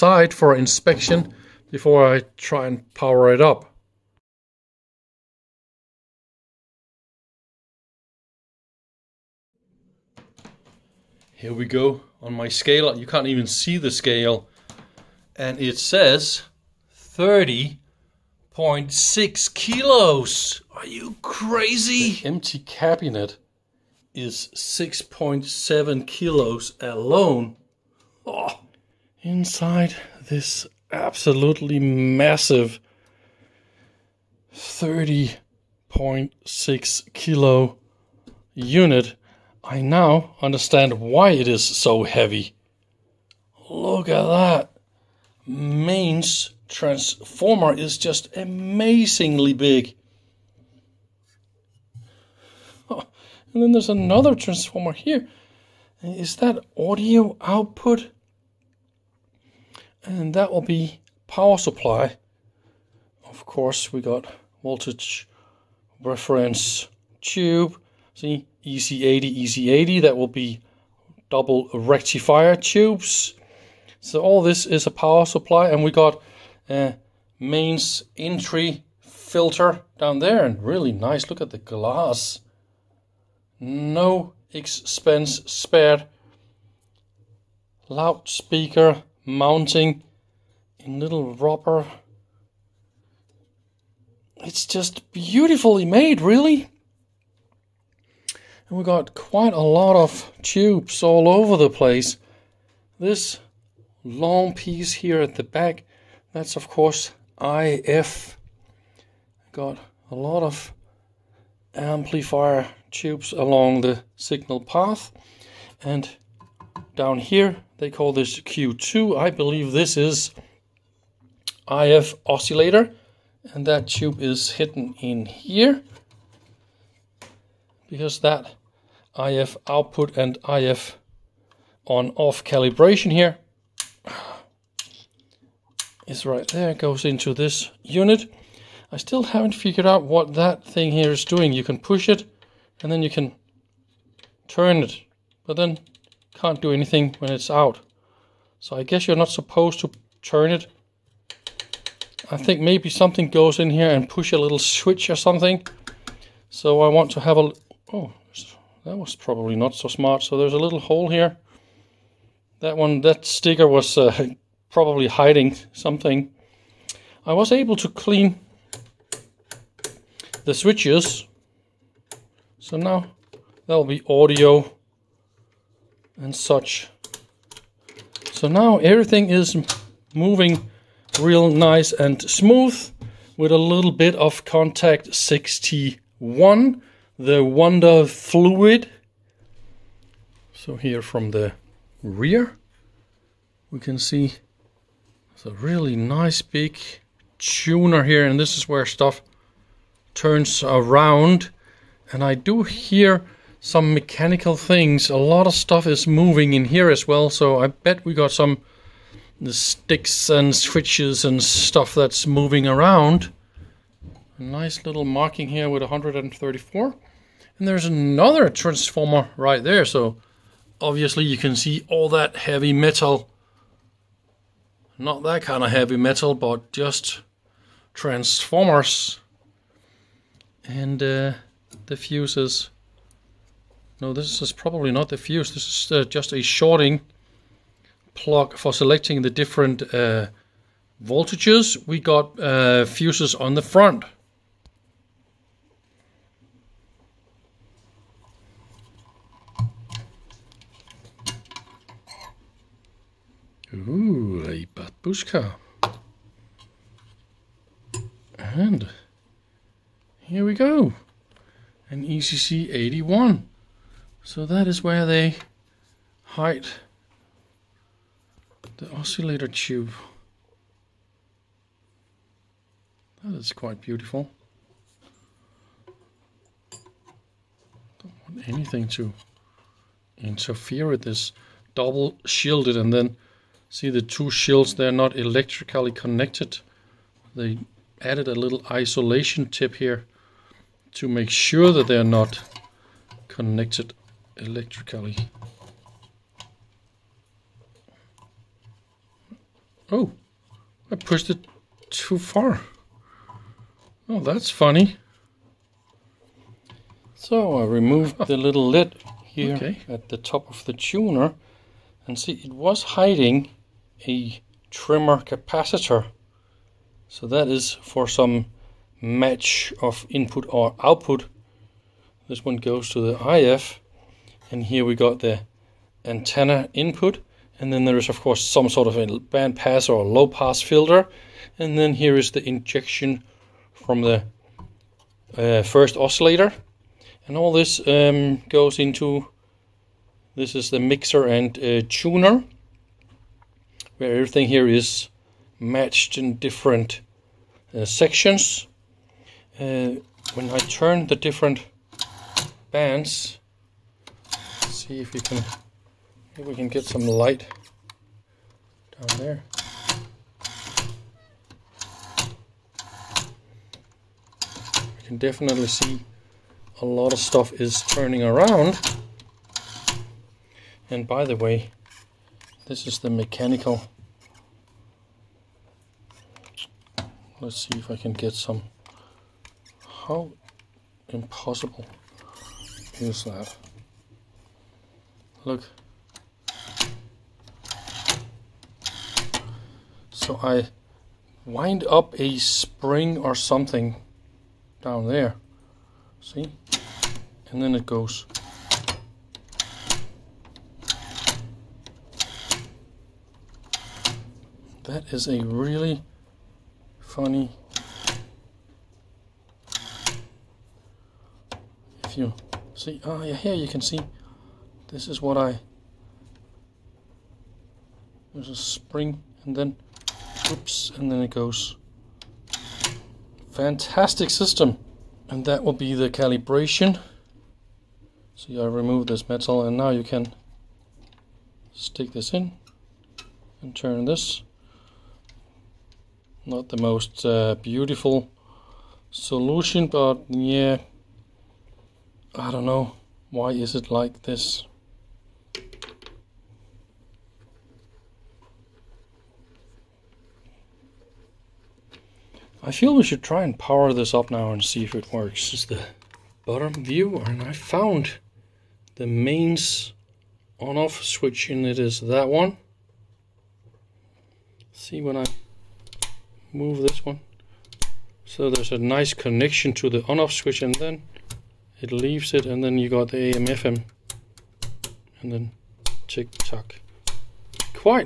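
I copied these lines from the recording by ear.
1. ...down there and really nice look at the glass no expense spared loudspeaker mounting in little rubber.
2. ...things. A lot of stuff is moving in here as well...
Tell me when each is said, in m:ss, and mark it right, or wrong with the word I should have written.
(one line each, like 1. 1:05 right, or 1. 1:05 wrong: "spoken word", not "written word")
1. 1:19 right
2. 3:24 right.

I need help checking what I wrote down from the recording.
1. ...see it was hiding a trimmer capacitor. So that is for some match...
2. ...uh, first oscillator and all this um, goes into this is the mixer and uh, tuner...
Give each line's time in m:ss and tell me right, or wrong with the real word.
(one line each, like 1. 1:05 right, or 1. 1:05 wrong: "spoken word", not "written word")
1. 5:12 right
2. 5:35 right.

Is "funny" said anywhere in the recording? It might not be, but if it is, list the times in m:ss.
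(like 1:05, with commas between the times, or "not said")
5:04, 6:46.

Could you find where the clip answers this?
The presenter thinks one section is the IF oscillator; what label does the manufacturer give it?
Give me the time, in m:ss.
1:58.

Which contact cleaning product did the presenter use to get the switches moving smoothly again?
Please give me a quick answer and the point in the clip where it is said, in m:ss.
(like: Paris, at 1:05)
Kontakt 61, at 3:04.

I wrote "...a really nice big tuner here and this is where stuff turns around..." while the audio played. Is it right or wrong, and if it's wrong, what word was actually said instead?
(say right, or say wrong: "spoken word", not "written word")
right.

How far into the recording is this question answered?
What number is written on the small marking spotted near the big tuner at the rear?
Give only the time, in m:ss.
3:35.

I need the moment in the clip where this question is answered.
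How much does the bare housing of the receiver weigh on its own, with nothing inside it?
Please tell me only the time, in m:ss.
0:24.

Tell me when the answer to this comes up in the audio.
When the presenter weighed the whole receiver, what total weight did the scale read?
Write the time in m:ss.
0:16.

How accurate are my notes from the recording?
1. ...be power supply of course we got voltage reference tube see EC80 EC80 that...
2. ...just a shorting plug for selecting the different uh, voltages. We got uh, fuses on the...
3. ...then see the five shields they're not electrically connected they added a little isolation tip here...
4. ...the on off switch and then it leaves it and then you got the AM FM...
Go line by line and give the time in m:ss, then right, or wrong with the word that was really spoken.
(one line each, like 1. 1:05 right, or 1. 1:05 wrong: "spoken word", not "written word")
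1. 1:00 right
2. 3:56 right
3. 4:42 wrong: "two", not "five"
4. 7:49 right.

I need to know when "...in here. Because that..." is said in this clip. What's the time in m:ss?
2:05.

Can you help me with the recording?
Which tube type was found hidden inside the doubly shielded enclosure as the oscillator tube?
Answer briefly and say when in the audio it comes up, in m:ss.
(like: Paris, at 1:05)
ECC 81, at 4:22.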